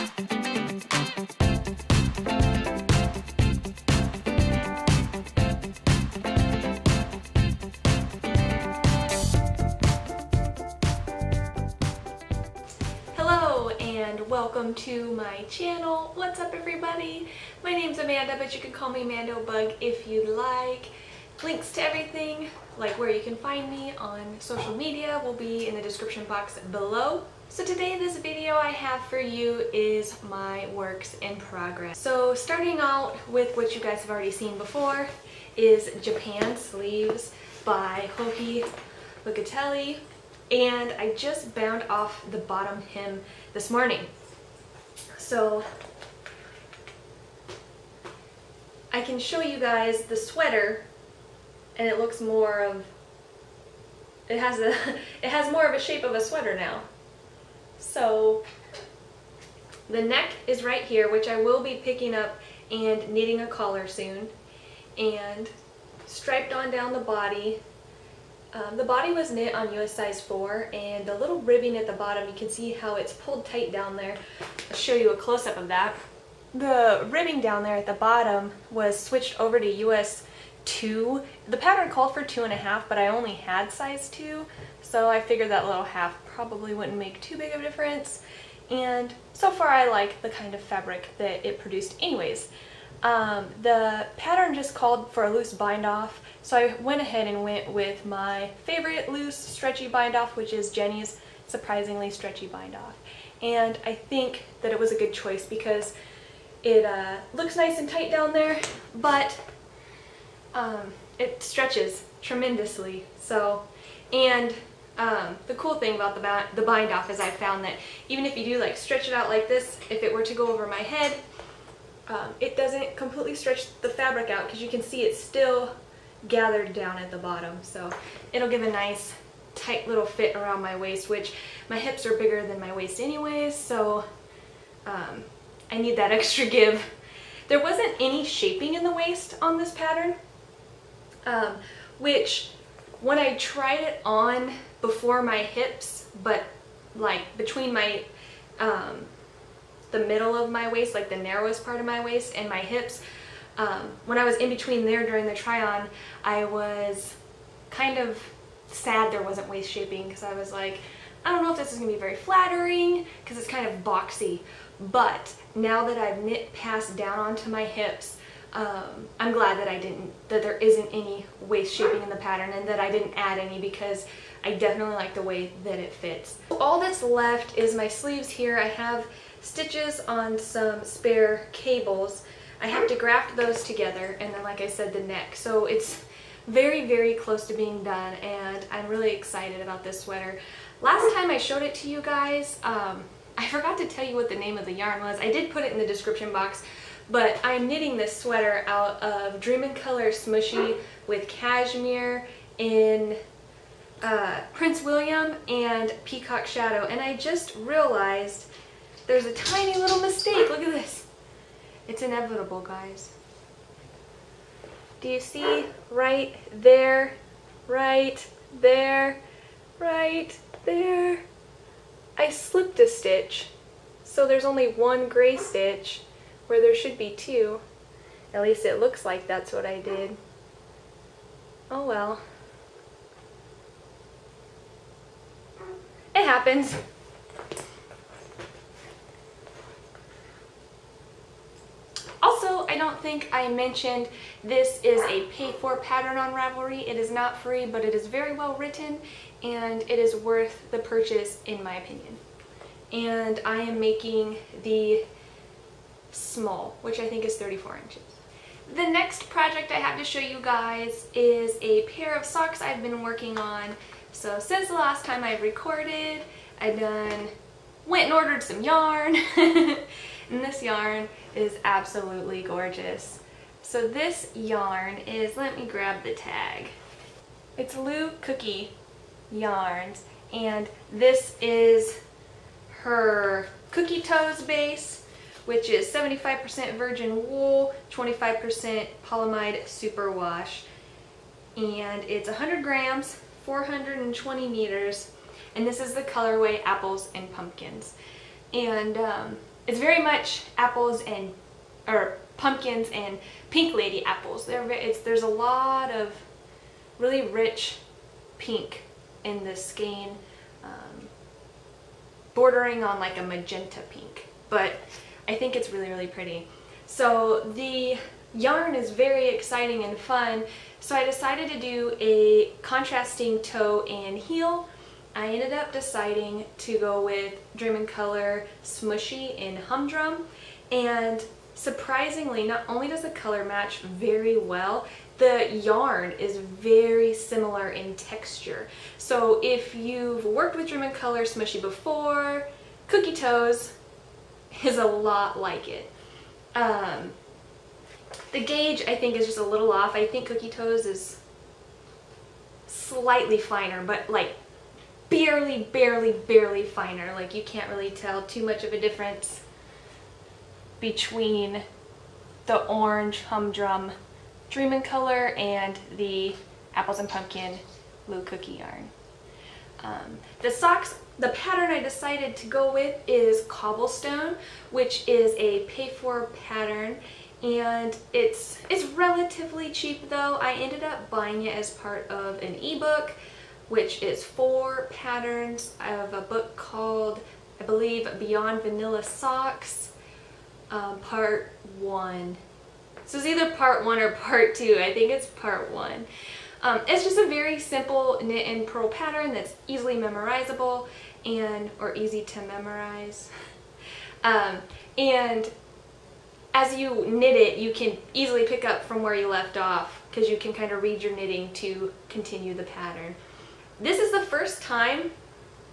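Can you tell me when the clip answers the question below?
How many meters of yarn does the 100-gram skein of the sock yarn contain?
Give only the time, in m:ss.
4:53.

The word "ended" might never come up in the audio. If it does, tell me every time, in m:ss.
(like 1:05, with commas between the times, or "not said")
5:25, 6:20.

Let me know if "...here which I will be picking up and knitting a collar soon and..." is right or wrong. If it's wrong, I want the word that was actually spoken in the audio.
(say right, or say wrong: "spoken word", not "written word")
right.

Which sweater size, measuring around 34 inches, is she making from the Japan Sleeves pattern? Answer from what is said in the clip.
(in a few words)
small.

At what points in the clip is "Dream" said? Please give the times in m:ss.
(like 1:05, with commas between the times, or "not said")
3:19, 5:27, 5:40, 6:04.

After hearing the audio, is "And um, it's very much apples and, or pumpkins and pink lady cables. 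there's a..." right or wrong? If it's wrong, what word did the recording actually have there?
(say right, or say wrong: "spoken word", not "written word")
wrong: "apples", not "cables".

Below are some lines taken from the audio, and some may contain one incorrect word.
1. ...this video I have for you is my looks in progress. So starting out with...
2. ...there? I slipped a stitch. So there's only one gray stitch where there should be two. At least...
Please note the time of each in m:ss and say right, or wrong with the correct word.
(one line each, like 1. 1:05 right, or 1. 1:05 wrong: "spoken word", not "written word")
1. 0:27 wrong: "works", not "looks"
2. 3:40 right.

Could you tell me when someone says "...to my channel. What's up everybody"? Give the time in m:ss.
0:14.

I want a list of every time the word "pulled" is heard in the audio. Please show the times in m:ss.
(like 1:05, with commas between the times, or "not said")
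1:13.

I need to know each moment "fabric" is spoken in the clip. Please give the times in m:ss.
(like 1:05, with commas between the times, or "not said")
1:30, 2:03.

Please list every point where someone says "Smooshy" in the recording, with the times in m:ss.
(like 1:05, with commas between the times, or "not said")
3:20, 5:28, 5:41.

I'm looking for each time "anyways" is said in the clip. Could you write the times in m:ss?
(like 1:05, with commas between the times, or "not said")
1:32, 2:12.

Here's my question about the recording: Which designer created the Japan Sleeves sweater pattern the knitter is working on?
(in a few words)
Joji Locatelli.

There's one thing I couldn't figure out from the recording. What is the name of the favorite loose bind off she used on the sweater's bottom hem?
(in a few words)
Jenny's surprisingly stretchy bind off.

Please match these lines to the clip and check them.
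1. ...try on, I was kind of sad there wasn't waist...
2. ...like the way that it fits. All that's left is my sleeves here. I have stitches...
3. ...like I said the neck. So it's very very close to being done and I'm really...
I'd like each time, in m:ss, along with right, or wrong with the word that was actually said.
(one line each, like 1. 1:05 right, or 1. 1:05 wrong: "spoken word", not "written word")
1. 2:35 right
2. 2:54 right
3. 3:04 right.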